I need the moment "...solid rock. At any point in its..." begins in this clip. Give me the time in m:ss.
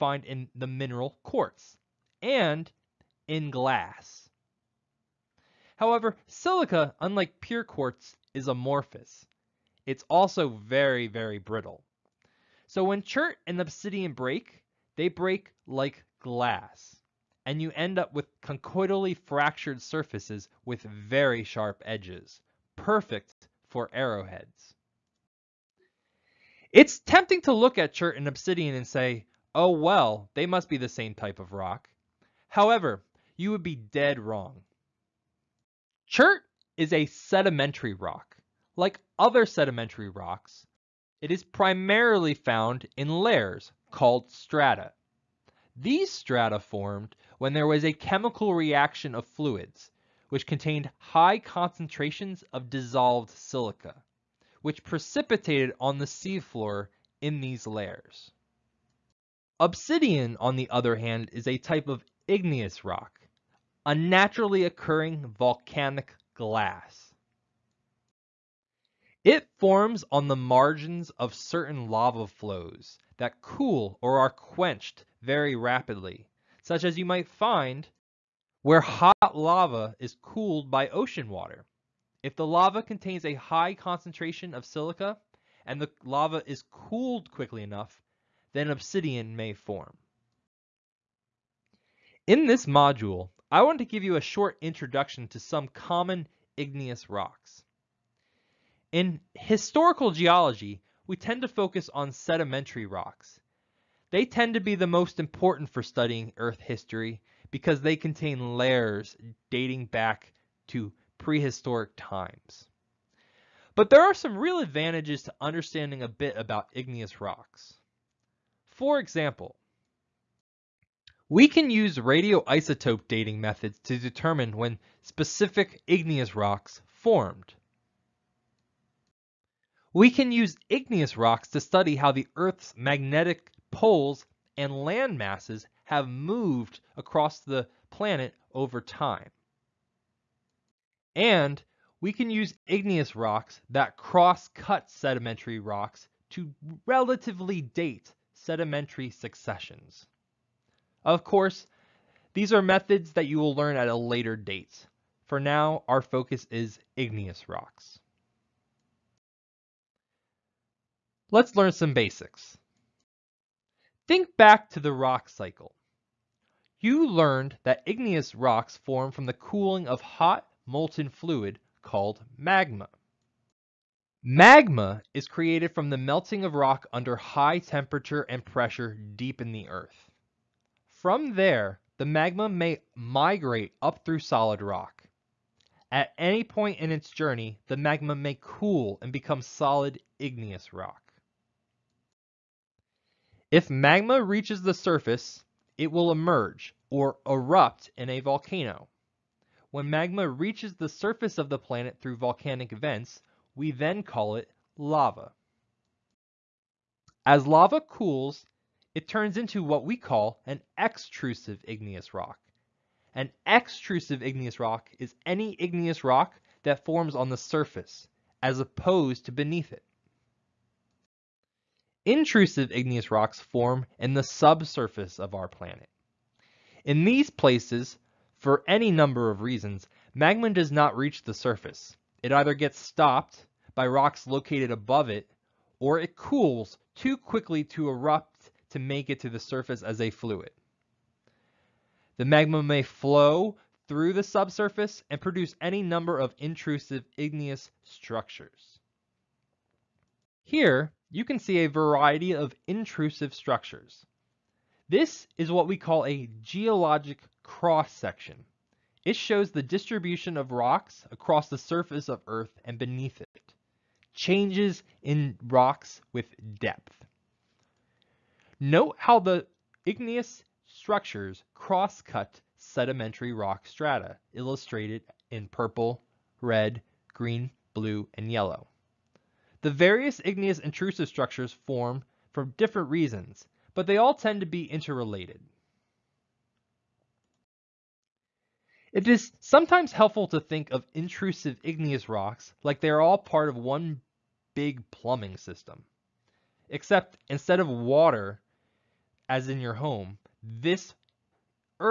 3:04.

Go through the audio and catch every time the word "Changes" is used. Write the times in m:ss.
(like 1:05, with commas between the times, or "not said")
4:24.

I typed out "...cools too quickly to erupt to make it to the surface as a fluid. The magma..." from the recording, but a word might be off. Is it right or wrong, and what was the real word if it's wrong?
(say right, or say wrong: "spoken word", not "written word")
right.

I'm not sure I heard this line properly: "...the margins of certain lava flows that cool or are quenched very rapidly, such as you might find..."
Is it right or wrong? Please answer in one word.
right.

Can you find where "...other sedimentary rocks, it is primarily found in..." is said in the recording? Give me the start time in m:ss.
0:39.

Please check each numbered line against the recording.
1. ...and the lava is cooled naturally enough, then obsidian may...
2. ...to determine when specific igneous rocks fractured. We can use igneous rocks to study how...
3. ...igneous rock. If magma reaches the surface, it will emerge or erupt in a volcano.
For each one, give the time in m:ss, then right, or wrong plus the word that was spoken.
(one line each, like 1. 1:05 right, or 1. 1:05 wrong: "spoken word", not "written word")
1. 1:25 wrong: "quickly", not "naturally"
2. 2:03 wrong: "formed", not "fractured"
3. 3:10 right.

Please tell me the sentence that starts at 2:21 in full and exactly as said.
And we can use igneous rocks that cross cut sedimentary rocks to relatively date sedimentary successions.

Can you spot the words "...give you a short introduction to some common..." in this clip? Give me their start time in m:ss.
1:33.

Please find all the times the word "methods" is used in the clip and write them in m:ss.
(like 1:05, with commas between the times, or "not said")
2:03, 2:32.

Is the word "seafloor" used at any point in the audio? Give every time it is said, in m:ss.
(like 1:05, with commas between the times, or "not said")
0:56.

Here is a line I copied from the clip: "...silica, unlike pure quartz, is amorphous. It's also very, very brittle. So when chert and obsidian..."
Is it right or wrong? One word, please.
right.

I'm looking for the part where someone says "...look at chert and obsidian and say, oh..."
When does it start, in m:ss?
0:27.